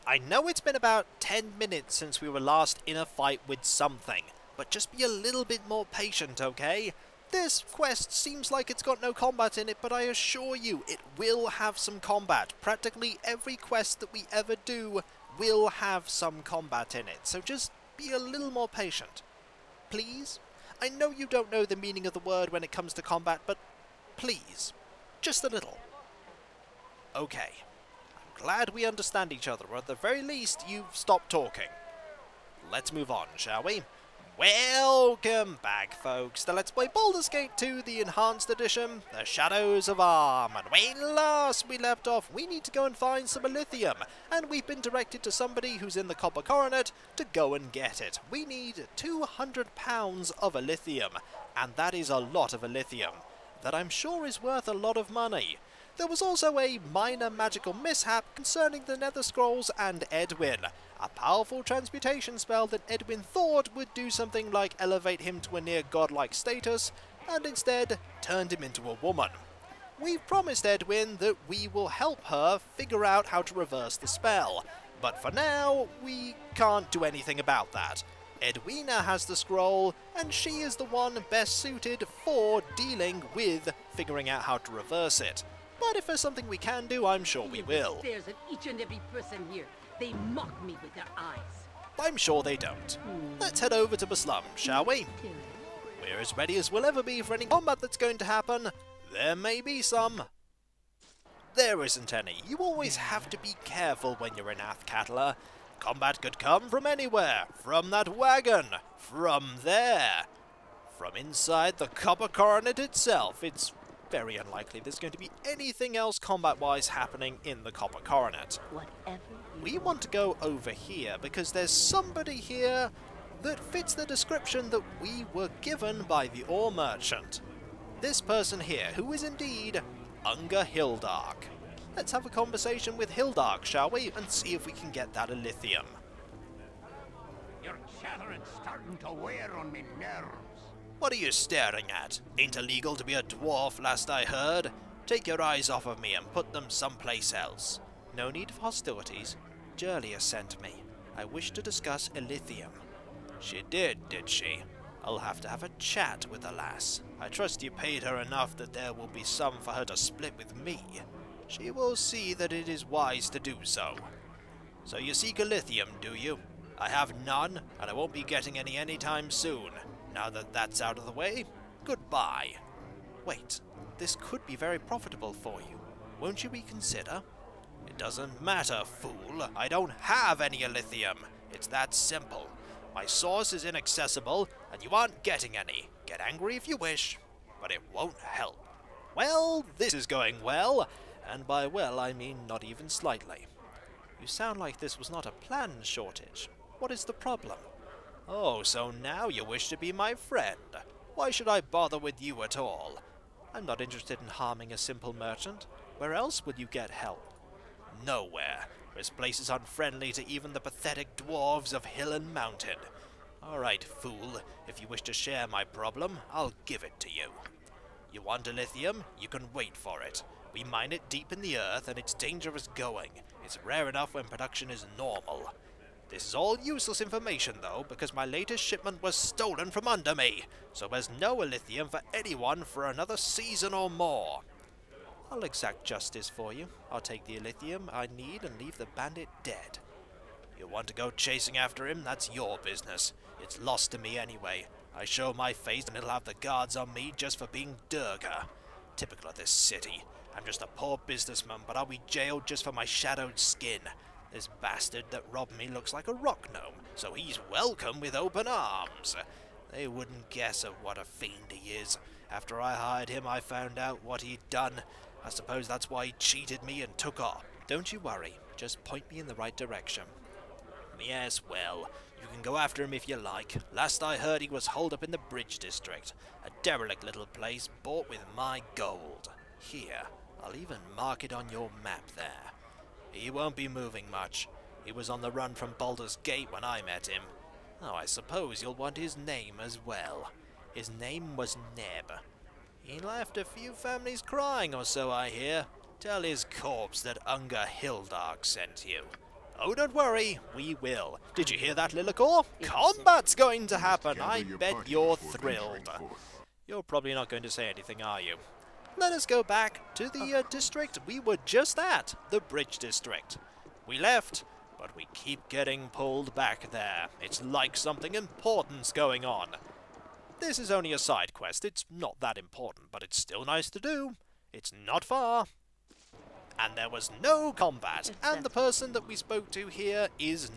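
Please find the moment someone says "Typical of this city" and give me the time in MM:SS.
04:08.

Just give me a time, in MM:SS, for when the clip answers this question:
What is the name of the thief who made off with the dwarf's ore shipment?
04:51.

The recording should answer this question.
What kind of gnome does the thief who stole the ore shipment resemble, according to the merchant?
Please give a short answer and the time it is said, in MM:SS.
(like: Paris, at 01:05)
rock gnome, at 04:16.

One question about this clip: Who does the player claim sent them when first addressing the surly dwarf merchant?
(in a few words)
Jurlia.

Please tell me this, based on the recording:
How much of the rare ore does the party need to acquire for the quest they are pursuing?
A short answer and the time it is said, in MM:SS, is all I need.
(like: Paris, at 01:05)
200 pounds, at 00:48.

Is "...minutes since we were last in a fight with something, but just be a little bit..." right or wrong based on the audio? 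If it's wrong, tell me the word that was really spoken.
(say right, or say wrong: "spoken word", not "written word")
right.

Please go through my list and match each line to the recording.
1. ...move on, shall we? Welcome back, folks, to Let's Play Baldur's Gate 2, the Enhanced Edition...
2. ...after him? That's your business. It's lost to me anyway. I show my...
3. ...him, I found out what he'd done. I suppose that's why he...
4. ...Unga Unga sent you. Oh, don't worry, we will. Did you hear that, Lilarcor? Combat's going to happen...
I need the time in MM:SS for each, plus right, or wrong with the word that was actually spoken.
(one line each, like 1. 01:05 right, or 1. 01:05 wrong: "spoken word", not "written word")
1. 00:32 right
2. 04:01 right
3. 04:23 right
4. 04:57 wrong: "Hildark", not "Unga".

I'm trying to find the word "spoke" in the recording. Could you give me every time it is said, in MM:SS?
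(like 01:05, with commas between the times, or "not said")
05:29.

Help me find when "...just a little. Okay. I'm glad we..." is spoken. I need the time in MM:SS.
00:25.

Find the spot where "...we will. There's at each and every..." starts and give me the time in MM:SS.
01:27.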